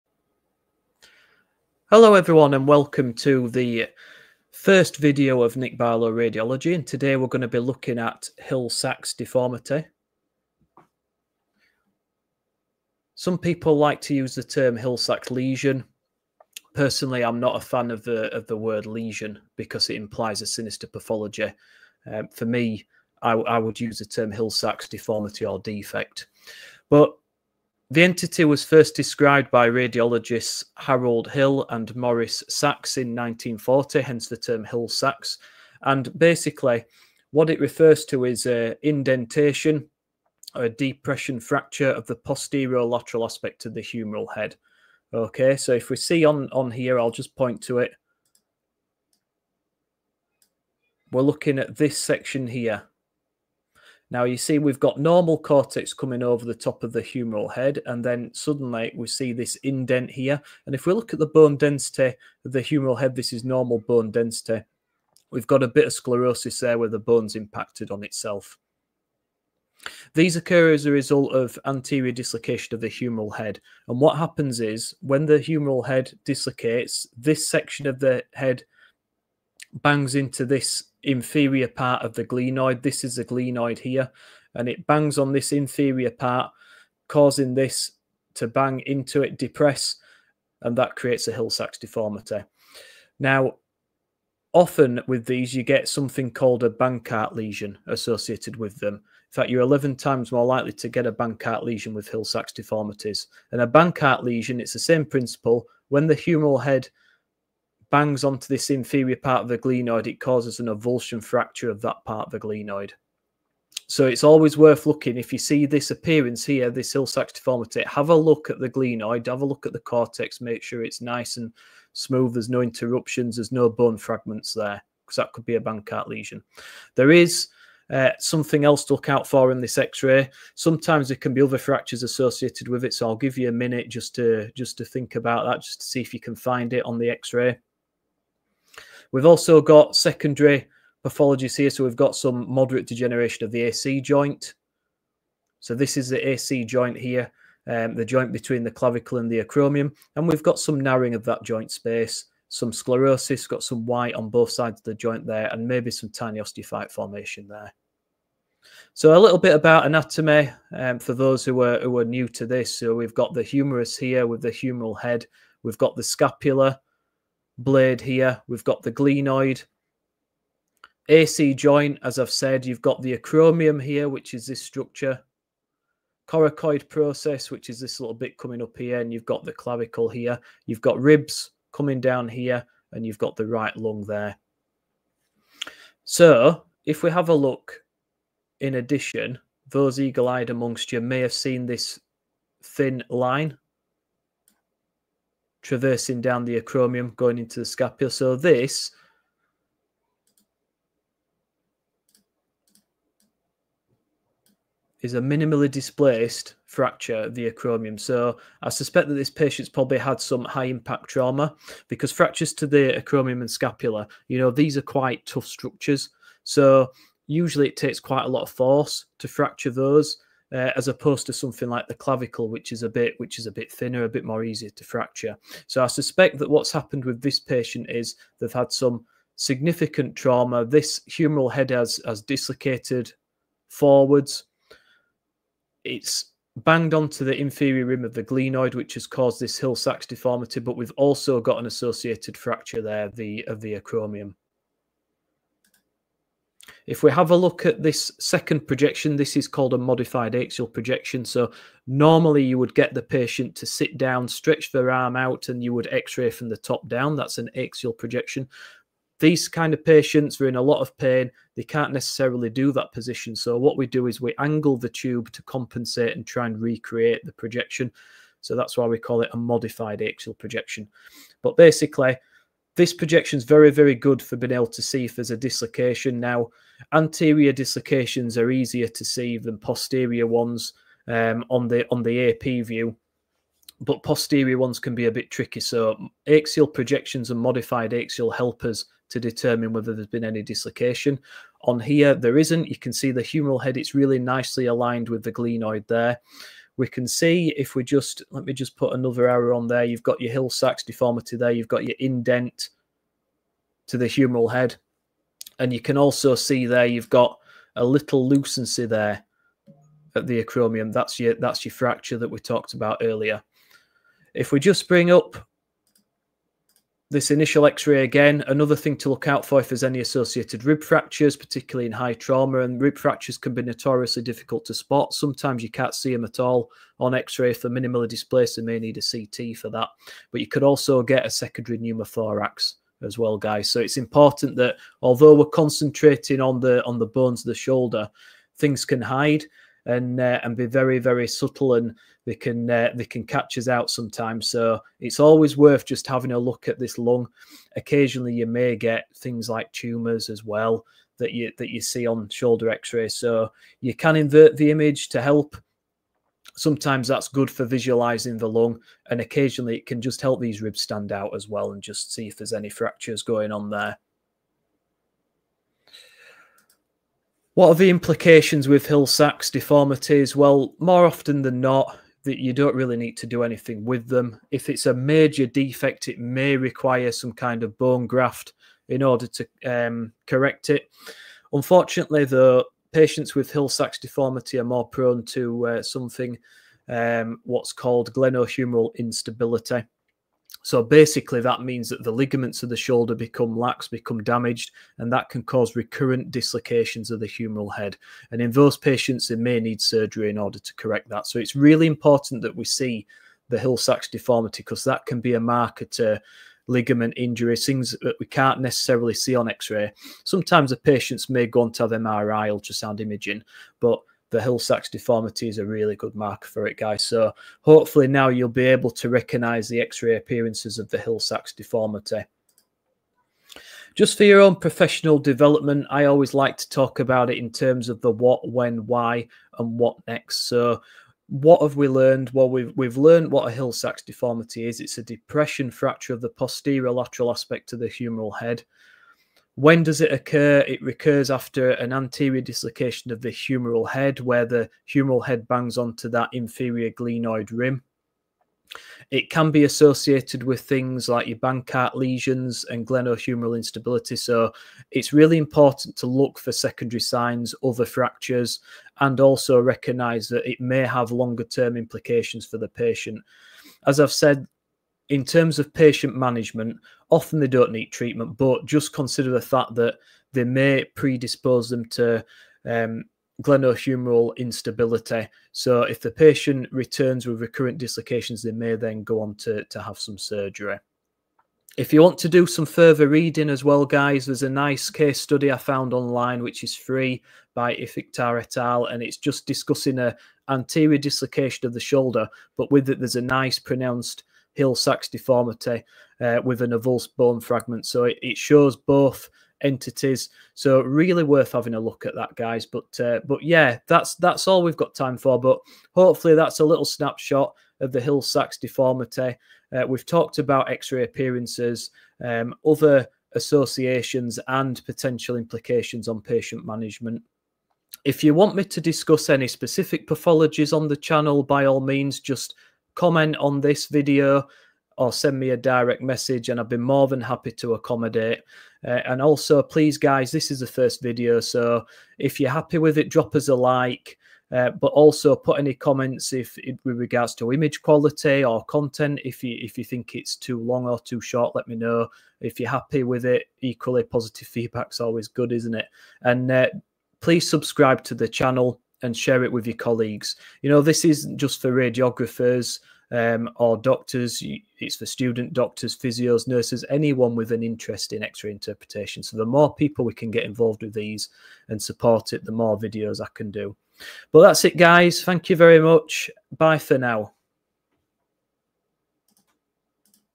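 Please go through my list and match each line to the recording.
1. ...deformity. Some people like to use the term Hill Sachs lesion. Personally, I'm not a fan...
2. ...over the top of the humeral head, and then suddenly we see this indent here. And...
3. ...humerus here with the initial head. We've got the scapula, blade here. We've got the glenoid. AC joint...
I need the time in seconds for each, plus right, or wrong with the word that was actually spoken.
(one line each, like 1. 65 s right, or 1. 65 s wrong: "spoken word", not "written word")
1. 9 s right
2. 56 s right
3. 163 s wrong: "humeral", not "initial".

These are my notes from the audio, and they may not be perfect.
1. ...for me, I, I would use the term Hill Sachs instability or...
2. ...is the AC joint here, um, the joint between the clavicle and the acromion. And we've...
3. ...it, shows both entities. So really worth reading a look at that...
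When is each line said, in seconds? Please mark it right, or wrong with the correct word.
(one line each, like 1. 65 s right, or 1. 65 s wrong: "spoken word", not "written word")
1. 22 s wrong: "deformity", not "instability"
2. 145 s right
3. 498 s wrong: "having", not "reading".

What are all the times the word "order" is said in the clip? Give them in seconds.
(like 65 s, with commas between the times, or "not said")
379 s, 400 s.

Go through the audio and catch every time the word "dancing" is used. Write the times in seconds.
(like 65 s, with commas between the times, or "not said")
not said.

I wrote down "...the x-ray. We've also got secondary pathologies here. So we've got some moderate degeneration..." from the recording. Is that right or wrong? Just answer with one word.
right.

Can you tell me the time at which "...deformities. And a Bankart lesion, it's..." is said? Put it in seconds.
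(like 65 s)
102 s.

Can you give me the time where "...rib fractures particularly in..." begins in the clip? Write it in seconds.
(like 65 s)
320 s.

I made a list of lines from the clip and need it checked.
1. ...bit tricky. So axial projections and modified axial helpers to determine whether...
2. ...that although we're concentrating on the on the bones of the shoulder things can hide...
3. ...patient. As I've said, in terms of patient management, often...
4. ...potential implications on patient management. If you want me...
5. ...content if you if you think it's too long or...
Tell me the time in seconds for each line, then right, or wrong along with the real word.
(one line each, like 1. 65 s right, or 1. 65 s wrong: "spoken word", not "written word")
1. 285 s right
2. 334 s right
3. 462 s right
4. 514 s right
5. 538 s right.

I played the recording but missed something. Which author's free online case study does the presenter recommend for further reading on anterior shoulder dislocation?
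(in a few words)
Iftikhar et al.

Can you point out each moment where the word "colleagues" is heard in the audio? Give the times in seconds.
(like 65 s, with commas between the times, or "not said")
549 s.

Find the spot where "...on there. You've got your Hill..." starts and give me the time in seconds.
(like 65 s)
299 s.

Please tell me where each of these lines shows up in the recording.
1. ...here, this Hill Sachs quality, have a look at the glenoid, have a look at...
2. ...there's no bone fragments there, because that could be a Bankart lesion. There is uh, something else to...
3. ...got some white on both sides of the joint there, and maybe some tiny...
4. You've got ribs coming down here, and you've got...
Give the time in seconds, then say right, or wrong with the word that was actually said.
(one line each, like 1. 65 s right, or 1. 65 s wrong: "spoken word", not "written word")
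1. 116 s wrong: "deformity", not "quality"
2. 123 s right
3. 153 s right
4. 180 s right.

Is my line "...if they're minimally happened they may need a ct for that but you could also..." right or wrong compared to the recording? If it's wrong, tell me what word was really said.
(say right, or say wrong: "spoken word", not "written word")
wrong: "displaced", not "happened".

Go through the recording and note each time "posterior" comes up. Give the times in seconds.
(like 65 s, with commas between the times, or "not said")
42 s, 279 s, 284 s, 436 s.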